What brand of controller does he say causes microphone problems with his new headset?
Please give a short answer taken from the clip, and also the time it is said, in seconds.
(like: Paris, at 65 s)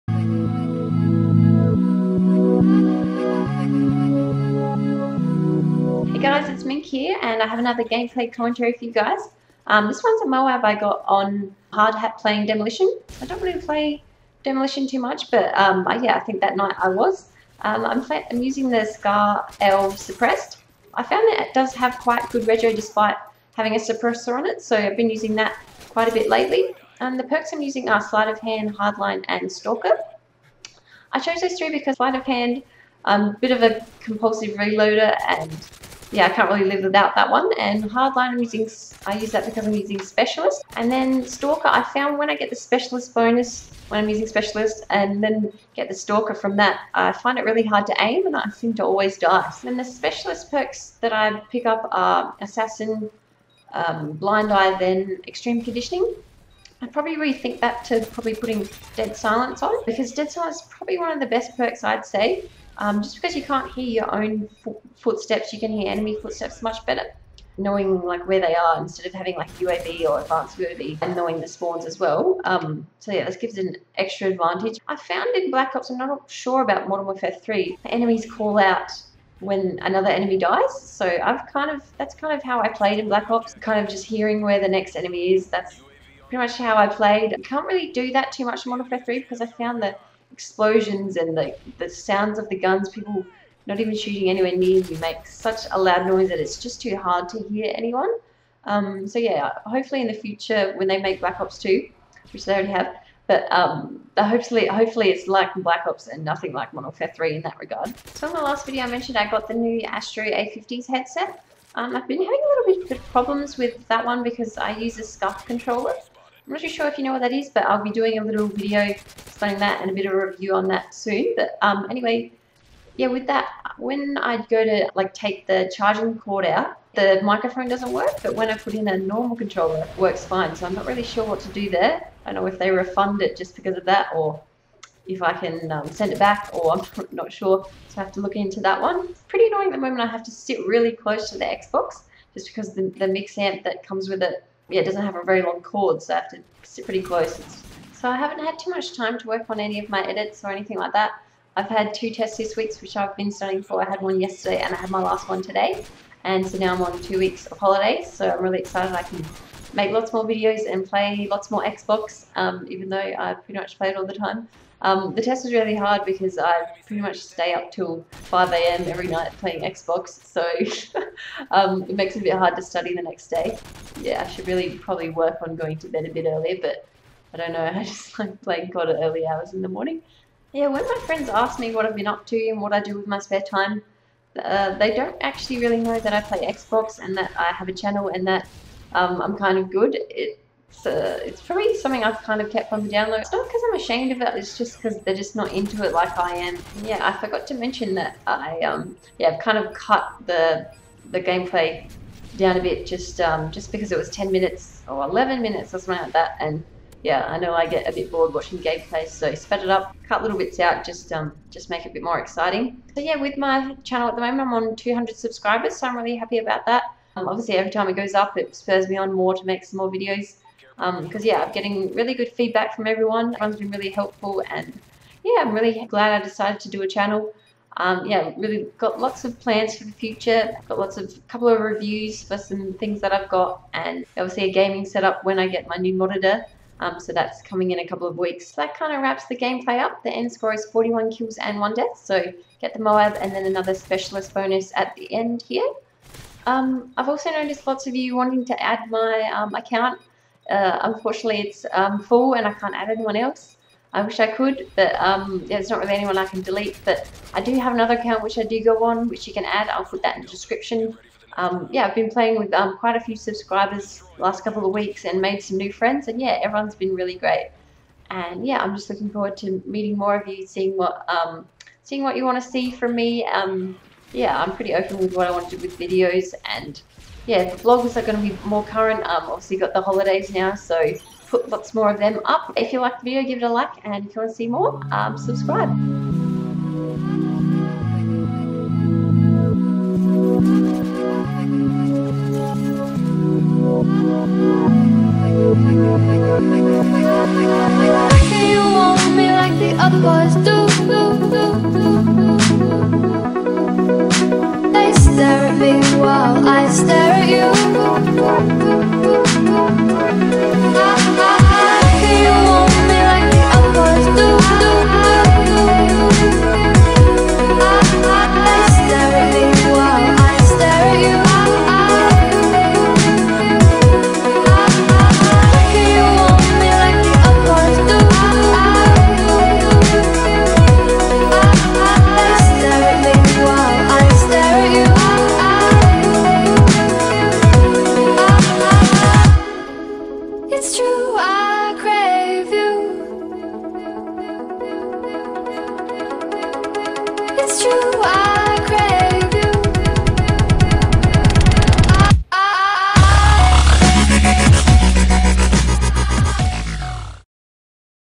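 SCUF, at 115 s.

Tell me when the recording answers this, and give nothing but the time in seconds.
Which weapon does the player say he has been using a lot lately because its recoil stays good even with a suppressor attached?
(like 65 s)
18 s.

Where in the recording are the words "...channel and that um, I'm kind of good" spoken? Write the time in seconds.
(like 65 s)
187 s.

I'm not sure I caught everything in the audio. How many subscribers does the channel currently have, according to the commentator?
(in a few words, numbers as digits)
200.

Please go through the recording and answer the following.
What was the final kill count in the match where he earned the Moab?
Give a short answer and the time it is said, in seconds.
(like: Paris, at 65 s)
41, at 240 s.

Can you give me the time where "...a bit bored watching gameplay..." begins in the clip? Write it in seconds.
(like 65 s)
207 s.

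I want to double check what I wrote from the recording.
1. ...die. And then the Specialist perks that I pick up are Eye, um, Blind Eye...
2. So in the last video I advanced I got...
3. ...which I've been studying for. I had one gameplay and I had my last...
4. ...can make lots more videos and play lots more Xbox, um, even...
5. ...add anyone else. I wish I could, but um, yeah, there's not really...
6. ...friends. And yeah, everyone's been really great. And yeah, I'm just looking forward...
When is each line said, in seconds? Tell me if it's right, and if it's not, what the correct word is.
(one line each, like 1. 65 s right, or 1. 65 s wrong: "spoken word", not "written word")
1. 49 s wrong: "Assassin", not "Eye"
2. 108 s wrong: "mentioned", not "advanced"
3. 152 s wrong: "yesterday", not "gameplay"
4. 159 s right
5. 252 s right
6. 265 s right.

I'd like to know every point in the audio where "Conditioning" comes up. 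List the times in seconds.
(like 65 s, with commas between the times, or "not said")
55 s.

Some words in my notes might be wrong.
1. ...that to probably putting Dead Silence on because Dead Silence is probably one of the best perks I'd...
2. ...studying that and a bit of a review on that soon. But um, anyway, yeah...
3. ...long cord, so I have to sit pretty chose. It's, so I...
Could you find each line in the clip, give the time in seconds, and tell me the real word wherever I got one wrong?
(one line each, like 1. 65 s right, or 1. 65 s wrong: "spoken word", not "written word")
1. 57 s right
2. 118 s wrong: "explaining", not "studying"
3. 145 s wrong: "close", not "chose".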